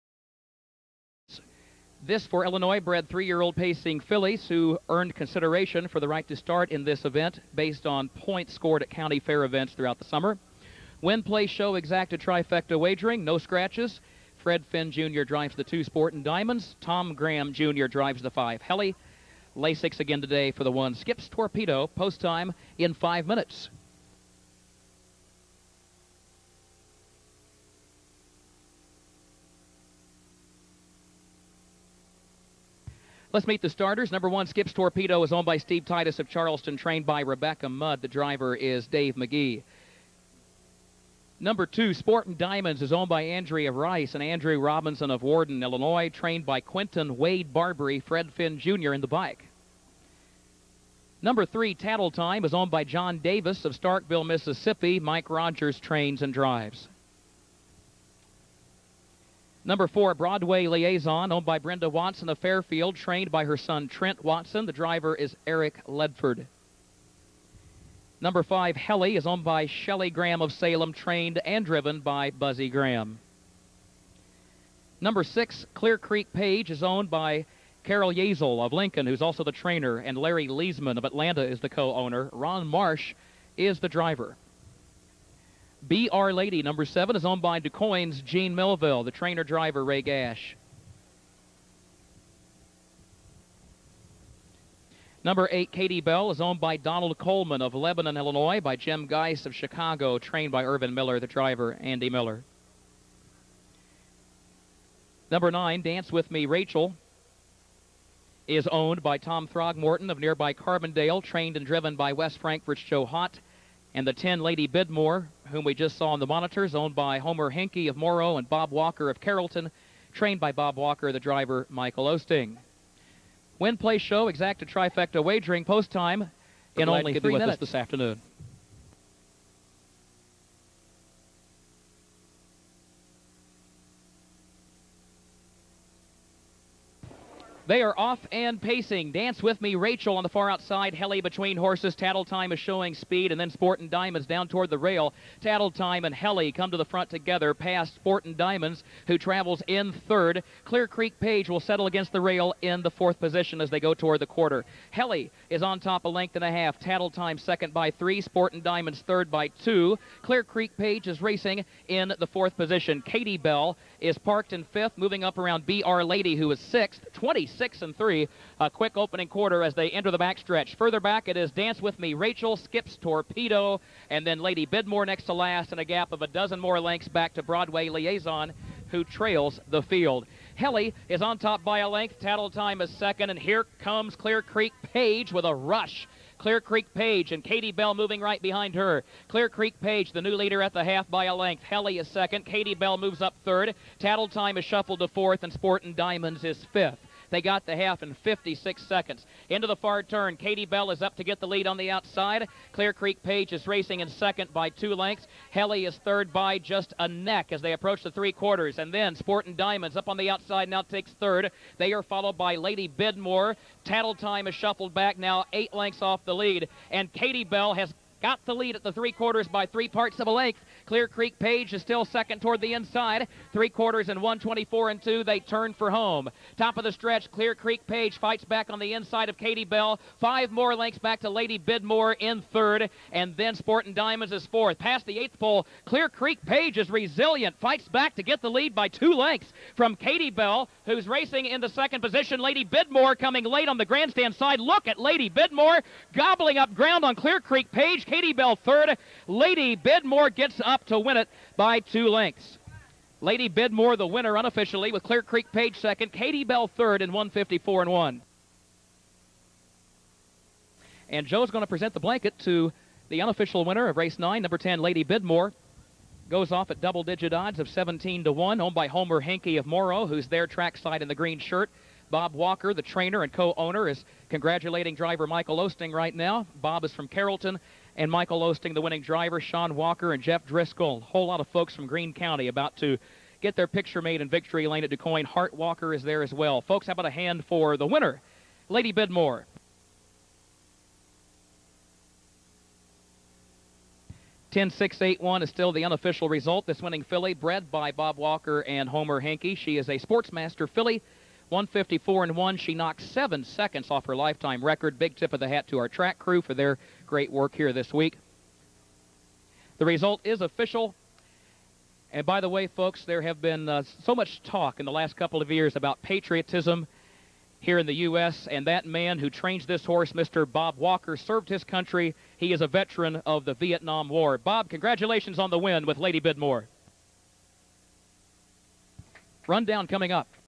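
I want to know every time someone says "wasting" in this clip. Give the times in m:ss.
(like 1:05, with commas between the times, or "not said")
not said.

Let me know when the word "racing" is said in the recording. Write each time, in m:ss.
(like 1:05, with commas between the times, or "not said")
2:41, 3:23, 4:01.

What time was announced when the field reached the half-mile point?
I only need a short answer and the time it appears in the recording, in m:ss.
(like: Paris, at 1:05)
56 seconds, at 3:17.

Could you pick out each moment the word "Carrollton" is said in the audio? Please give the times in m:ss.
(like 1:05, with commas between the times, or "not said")
1:59, 4:37.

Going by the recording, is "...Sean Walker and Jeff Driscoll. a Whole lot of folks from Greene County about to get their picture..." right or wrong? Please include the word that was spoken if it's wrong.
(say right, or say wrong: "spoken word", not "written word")
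right.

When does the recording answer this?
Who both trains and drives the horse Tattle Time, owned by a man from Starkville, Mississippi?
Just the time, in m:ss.
0:54.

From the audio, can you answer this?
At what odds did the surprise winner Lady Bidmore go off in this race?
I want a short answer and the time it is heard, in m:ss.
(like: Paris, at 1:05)
17 to 1, at 4:27.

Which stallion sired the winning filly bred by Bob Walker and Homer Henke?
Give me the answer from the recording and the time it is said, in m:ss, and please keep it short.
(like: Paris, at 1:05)
Sportsmaster, at 4:59.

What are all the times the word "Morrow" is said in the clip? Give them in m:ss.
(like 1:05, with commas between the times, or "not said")
1:57, 4:29.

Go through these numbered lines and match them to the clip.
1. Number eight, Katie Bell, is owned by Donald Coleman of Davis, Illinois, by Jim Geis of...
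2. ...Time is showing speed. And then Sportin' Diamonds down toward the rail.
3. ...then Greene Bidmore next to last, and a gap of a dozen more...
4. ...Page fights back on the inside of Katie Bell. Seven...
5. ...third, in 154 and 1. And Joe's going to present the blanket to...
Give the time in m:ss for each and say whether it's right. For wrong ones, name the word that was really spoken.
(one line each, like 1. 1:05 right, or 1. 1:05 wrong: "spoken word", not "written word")
1. 1:35 wrong: "Lebanon", not "Davis"
2. 2:22 right
3. 2:54 wrong: "Lady", not "Greene"
4. 3:47 wrong: "Five", not "Seven"
5. 4:16 right.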